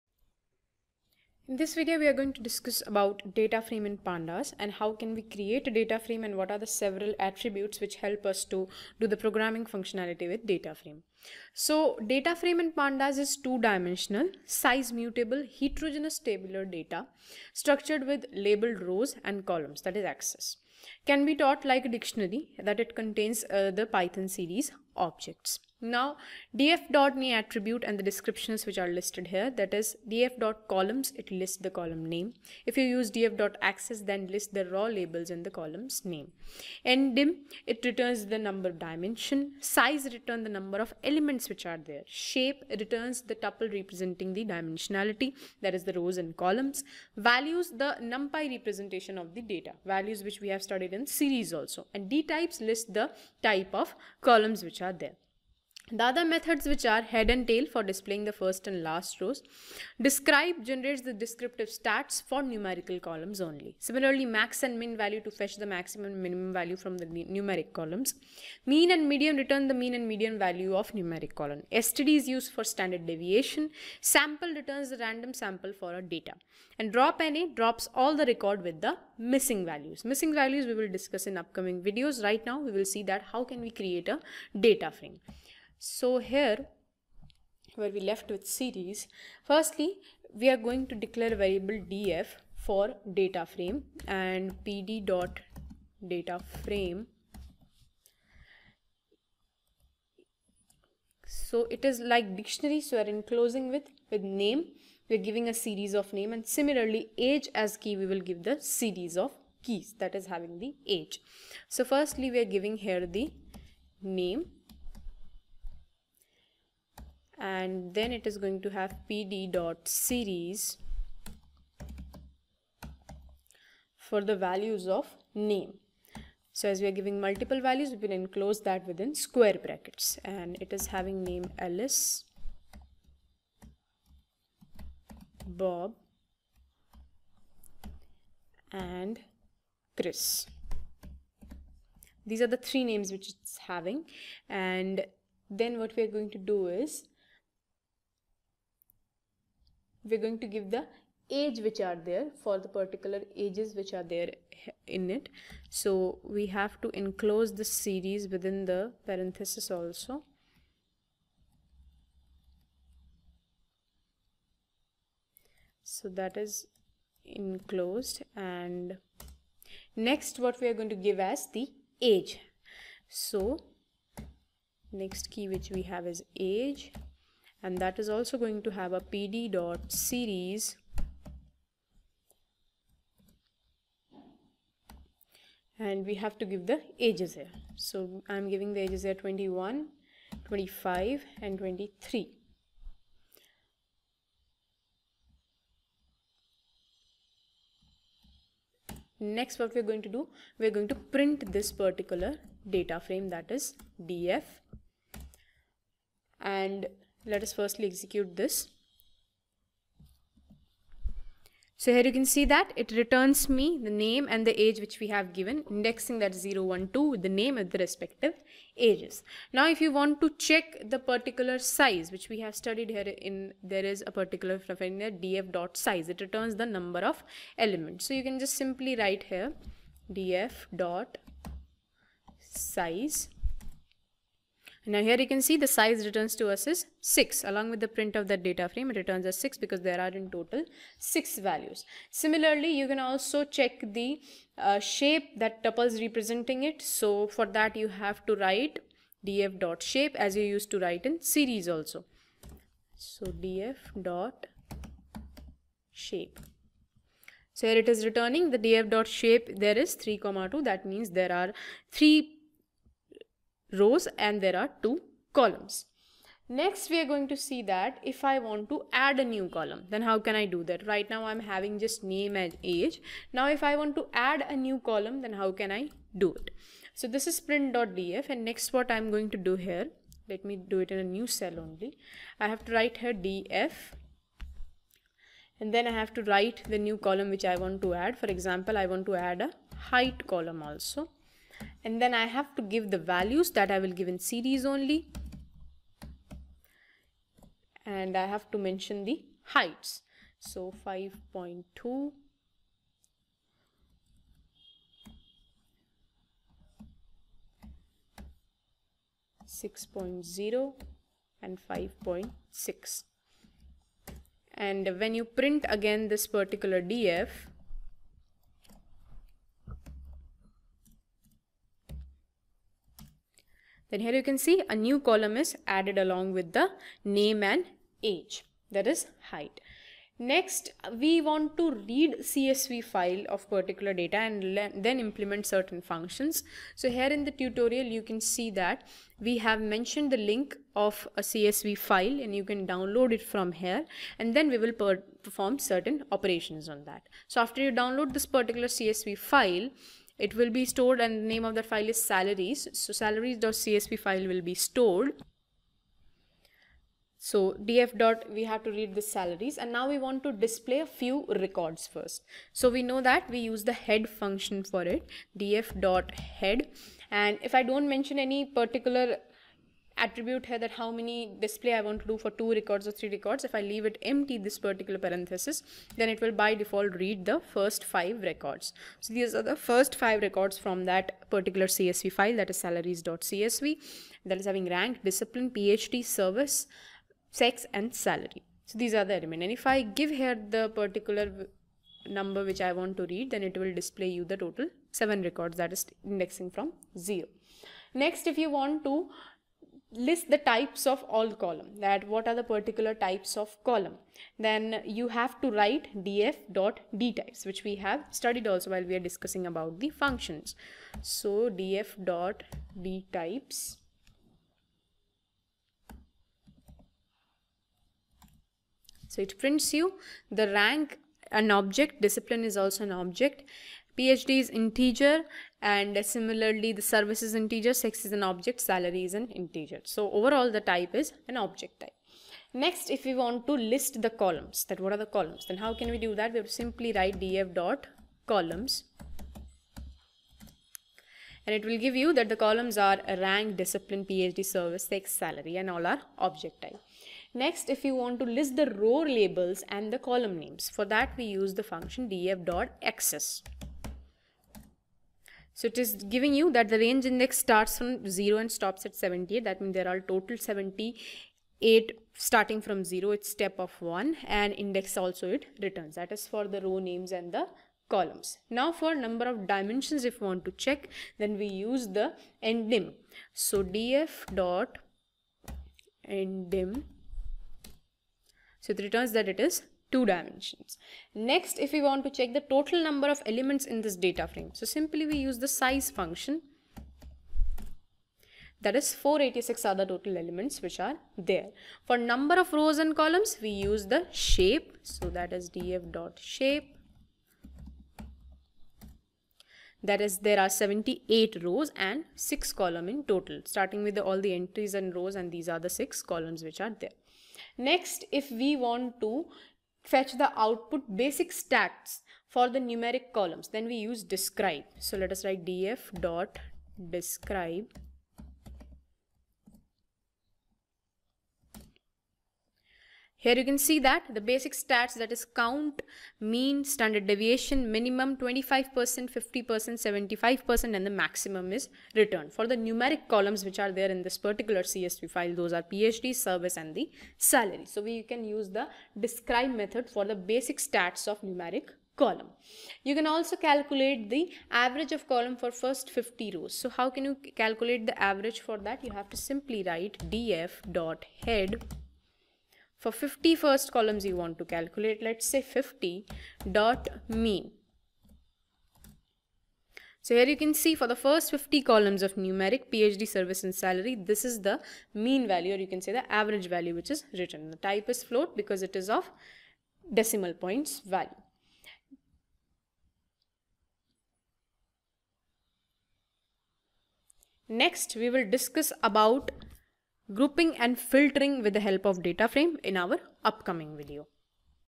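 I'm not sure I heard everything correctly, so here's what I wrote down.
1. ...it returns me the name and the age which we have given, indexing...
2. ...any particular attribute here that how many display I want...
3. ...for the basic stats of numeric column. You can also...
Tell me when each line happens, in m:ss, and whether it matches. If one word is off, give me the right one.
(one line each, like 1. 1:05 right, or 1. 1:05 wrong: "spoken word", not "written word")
1. 3:32 right
2. 6:08 right
3. 8:59 right.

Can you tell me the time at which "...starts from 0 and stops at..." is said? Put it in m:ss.
7:37.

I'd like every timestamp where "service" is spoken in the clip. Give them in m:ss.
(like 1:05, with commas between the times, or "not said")
6:26, 7:06, 7:24, 8:56, 9:23.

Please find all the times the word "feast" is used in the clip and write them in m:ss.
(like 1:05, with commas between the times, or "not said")
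not said.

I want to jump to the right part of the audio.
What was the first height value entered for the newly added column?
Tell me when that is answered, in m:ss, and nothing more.
5:00.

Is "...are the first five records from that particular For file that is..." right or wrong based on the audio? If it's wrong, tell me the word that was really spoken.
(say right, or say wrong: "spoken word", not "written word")
wrong: "CSV", not "For".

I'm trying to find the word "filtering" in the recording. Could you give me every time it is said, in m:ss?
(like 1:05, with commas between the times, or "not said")
9:40.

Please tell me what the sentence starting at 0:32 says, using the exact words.
If you use df then list the raw labels in the columns name.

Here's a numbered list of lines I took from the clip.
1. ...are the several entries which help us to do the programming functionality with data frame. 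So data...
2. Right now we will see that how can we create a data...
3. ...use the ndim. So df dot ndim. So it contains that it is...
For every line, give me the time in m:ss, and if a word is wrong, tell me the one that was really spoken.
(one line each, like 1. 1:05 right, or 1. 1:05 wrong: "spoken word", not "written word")
1. 0:06 wrong: "attributes", not "entries"
2. 1:22 right
3. 7:51 wrong: "returns", not "contains".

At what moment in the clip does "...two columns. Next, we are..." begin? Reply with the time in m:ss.
4:24.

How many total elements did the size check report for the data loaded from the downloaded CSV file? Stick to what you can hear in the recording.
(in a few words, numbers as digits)
486.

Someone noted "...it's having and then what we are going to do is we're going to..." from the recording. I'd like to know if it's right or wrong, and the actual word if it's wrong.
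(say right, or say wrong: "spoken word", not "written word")
right.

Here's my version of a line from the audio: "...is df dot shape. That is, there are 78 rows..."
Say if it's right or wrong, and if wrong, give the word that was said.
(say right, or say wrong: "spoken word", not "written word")
right.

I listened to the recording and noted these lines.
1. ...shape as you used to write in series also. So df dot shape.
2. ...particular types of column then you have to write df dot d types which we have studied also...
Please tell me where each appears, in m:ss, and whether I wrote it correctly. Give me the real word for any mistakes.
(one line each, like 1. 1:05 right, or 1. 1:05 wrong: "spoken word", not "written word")
1. 4:09 right
2. 6:42 right.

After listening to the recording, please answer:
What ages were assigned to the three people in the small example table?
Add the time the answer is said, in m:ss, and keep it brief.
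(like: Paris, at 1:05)
21, 25 and 23, at 3:09.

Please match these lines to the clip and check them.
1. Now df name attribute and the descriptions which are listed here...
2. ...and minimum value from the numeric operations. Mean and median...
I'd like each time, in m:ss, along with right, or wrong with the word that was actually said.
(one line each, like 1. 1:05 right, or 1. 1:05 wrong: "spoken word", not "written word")
1. 0:25 right
2. 1:06 wrong: "columns", not "operations".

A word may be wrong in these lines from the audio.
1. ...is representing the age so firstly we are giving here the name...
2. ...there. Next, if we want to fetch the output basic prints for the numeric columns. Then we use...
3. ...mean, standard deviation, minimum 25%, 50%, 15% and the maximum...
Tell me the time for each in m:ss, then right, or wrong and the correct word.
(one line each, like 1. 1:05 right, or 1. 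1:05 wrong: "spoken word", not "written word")
1. 1:50 wrong: "having", not "representing"
2. 8:26 wrong: "stats", not "prints"
3. 8:46 wrong: "75", not "15".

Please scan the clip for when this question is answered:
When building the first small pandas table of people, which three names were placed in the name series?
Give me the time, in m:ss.
2:11.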